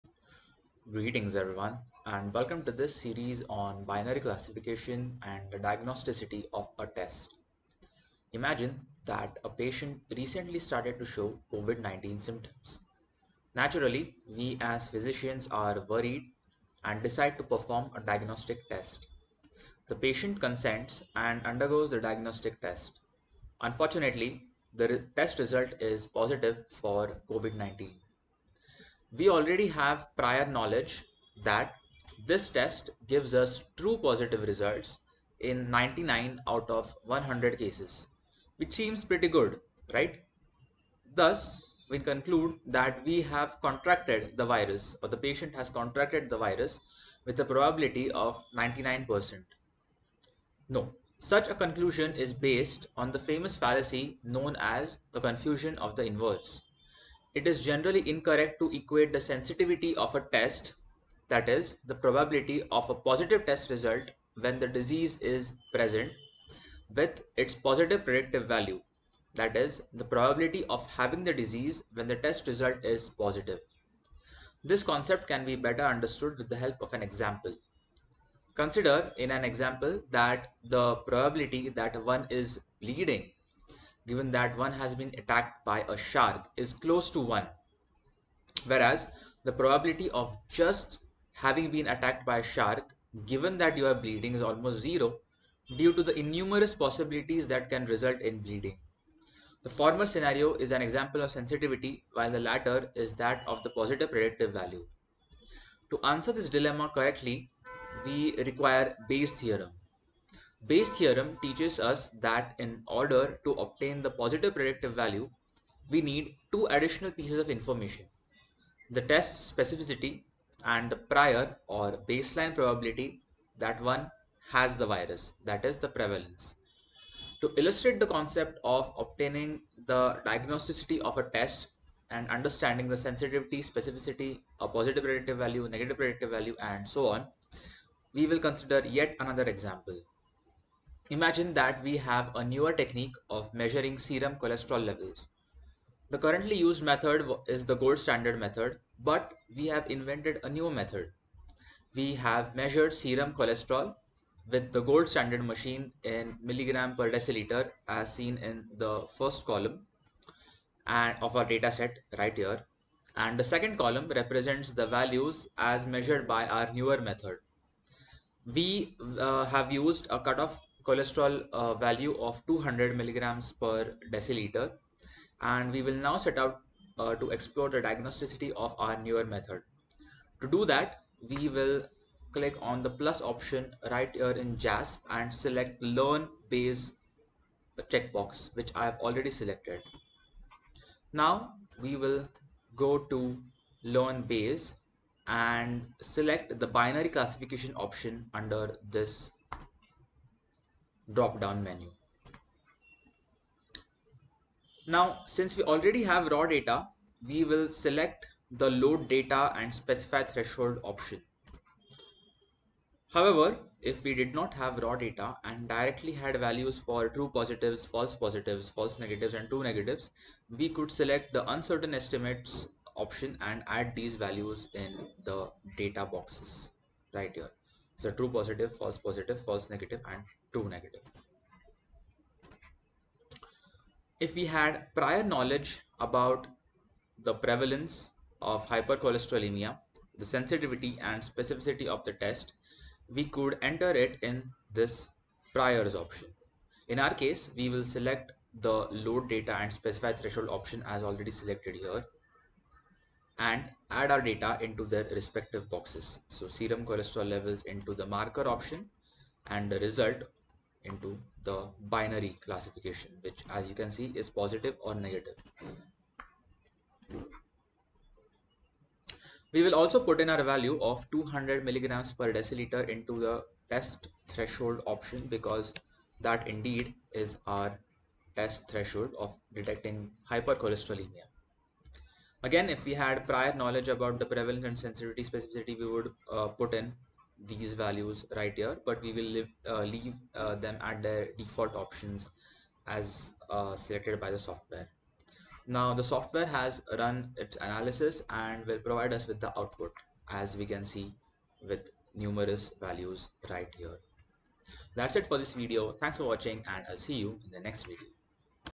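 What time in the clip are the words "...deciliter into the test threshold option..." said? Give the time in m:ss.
4:32.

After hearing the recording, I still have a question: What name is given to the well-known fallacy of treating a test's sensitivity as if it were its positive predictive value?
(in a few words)
confusion of the inverse.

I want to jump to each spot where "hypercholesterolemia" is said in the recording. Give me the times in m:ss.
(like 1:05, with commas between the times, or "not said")
3:58, 4:40.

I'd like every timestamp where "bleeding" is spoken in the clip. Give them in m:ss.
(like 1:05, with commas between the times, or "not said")
1:22, 1:34, 1:38.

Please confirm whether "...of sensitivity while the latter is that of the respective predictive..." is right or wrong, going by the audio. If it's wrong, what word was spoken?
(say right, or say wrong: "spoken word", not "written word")
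wrong: "positive", not "respective".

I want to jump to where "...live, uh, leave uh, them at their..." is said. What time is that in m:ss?
4:49.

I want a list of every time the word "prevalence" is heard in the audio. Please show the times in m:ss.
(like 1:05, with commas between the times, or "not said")
2:05, 3:57, 4:44.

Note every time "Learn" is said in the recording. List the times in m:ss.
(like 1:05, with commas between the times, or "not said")
3:05, 3:13.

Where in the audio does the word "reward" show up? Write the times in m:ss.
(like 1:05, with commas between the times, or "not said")
not said.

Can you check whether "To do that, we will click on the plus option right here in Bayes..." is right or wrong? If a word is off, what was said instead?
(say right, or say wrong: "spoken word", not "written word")
wrong: "JASP", not "Bayes".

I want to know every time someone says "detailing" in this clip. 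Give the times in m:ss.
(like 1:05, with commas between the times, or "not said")
not said.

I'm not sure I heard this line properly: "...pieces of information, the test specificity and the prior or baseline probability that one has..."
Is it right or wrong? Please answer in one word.
right.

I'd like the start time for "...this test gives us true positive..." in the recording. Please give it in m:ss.
0:32.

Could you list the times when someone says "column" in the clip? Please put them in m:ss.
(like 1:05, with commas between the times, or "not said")
2:39, 2:43.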